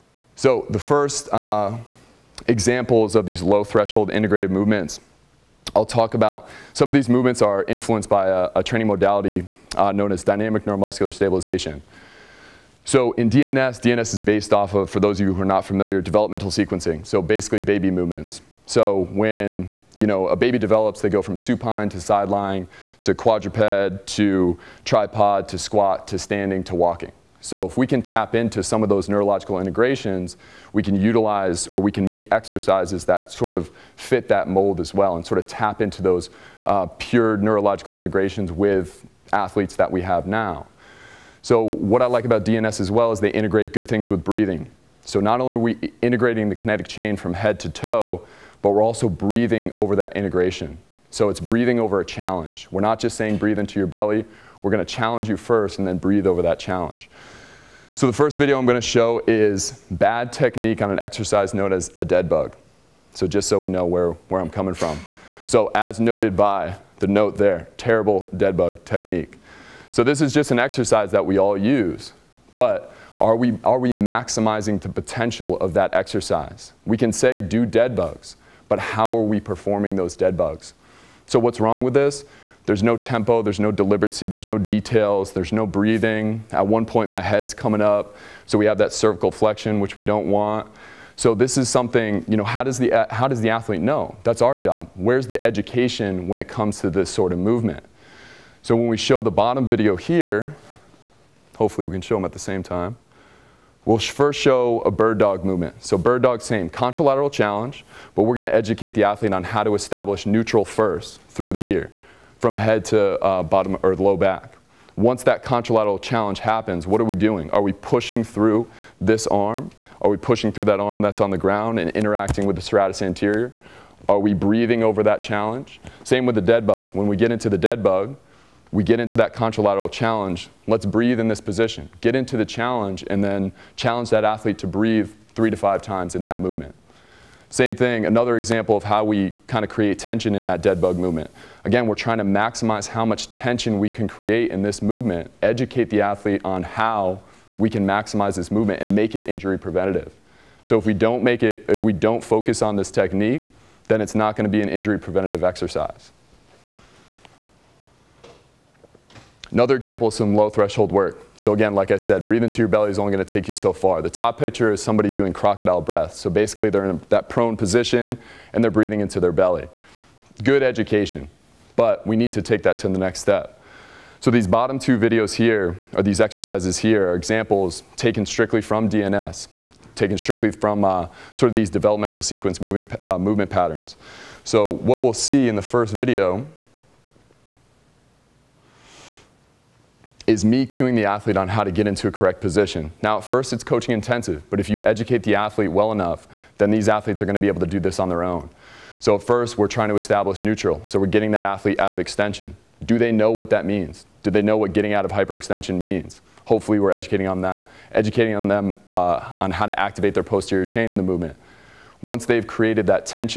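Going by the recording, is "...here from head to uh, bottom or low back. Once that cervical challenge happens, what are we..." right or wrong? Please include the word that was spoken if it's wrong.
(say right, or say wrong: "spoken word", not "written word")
wrong: "contralateral", not "cervical".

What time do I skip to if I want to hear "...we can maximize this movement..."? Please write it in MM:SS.
02:27.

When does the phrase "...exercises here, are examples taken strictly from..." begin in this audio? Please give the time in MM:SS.
02:56.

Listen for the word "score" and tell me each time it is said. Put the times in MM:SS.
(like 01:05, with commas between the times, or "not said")
not said.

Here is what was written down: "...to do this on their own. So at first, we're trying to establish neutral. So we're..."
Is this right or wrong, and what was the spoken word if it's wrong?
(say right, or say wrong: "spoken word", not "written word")
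right.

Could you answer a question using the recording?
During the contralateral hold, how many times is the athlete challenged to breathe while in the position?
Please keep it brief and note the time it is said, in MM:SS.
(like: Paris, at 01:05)
3 to 5, at 02:15.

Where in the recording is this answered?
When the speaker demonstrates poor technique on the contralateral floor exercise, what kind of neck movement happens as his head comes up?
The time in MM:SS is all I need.
01:28.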